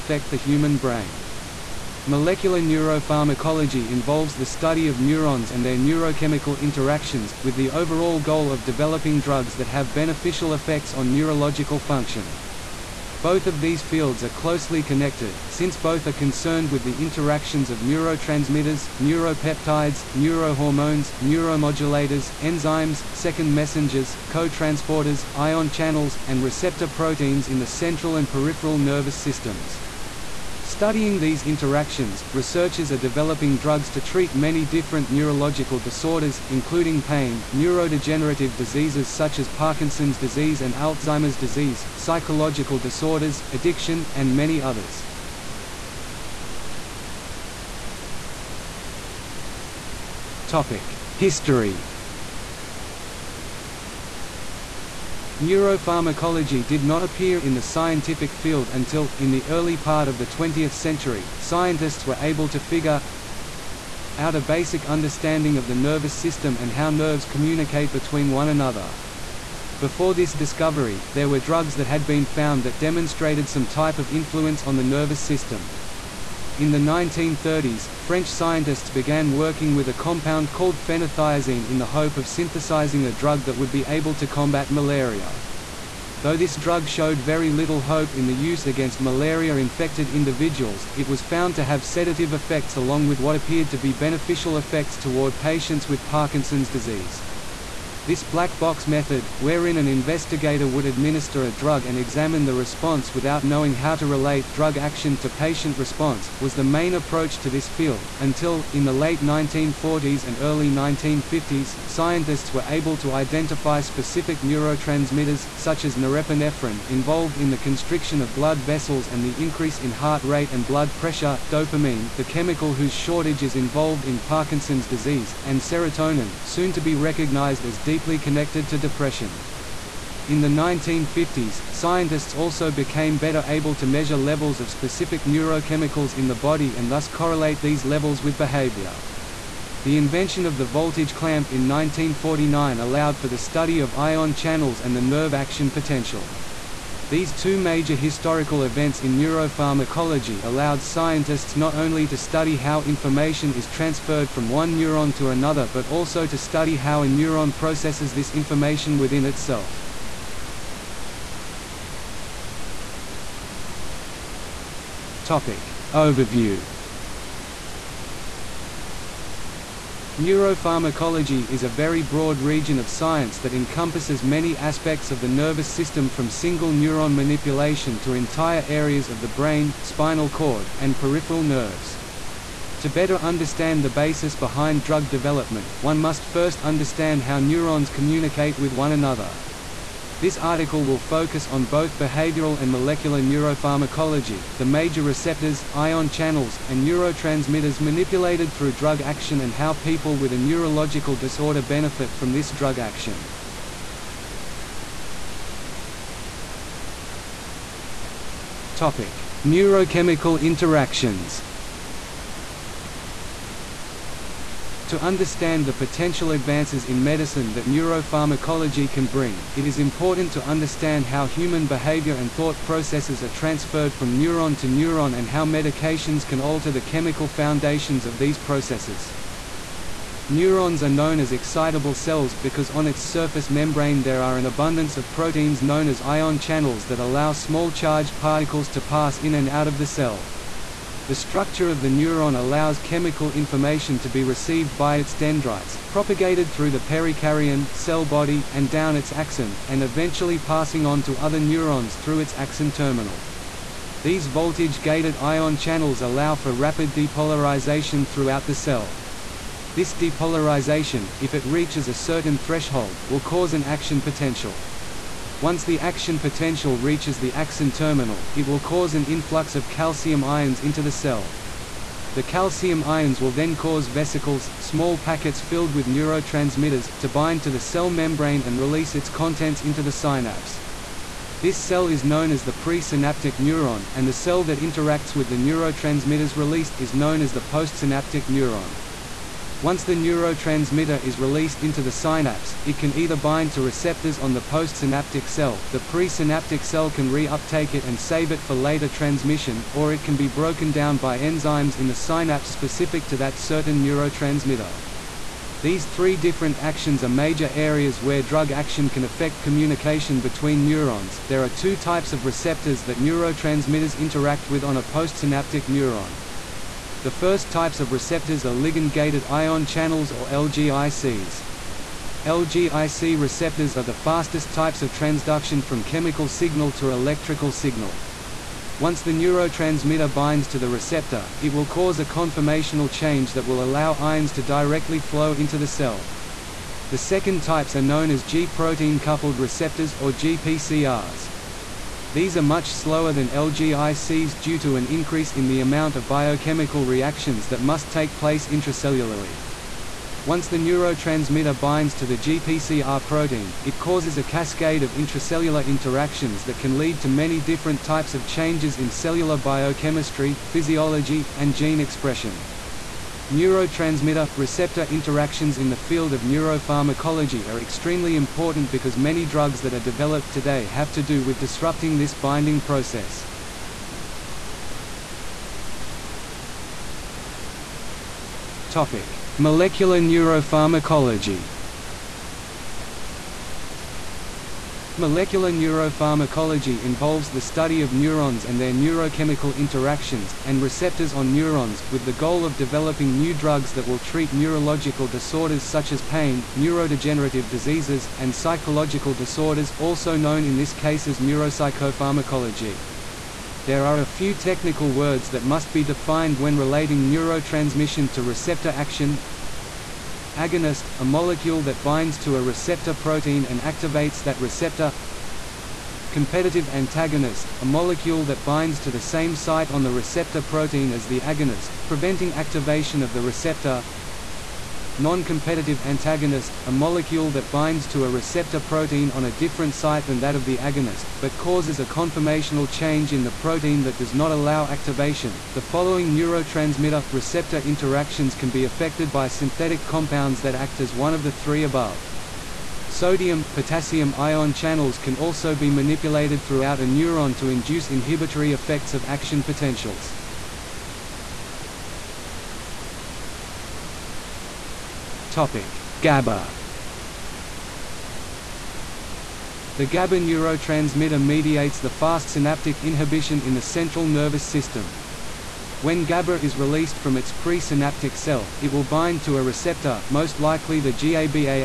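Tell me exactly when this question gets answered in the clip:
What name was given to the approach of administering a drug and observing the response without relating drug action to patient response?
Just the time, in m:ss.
1:38.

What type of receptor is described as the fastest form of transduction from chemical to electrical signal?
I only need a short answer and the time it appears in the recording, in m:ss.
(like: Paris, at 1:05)
ligand-gated ion channels, at 5:18.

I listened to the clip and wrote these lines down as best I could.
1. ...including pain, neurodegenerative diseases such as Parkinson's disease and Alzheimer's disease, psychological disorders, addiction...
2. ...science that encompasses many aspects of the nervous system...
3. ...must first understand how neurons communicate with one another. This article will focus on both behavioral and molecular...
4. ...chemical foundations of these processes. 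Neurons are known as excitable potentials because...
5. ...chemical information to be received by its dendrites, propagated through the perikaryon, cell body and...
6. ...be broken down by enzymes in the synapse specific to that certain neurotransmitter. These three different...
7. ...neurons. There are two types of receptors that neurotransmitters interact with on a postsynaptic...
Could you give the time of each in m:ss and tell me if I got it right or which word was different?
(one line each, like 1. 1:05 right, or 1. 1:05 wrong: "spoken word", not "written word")
1. 0:36 right
2. 2:52 right
3. 3:05 right
4. 3:46 wrong: "cells", not "potentials"
5. 4:02 right
6. 5:00 right
7. 5:10 right.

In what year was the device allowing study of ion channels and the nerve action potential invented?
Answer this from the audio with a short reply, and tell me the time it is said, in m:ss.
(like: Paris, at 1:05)
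1949, at 2:21.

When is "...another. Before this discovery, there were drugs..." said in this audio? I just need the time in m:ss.
1:08.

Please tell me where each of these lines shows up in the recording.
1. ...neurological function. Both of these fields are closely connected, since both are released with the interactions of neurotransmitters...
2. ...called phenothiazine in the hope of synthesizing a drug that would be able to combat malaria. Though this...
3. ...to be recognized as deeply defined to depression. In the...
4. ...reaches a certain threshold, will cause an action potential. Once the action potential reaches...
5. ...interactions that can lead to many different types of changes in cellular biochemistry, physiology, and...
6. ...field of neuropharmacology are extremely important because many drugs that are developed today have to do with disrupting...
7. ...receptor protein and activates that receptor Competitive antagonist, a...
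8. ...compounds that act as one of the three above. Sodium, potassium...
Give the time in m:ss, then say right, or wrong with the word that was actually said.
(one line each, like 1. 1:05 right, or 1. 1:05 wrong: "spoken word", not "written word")
1. 0:11 wrong: "concerned", not "released"
2. 1:20 right
3. 2:06 wrong: "connected", not "defined"
4. 4:21 right
5. 5:55 right
6. 6:05 right
7. 6:52 right
8. 7:19 right.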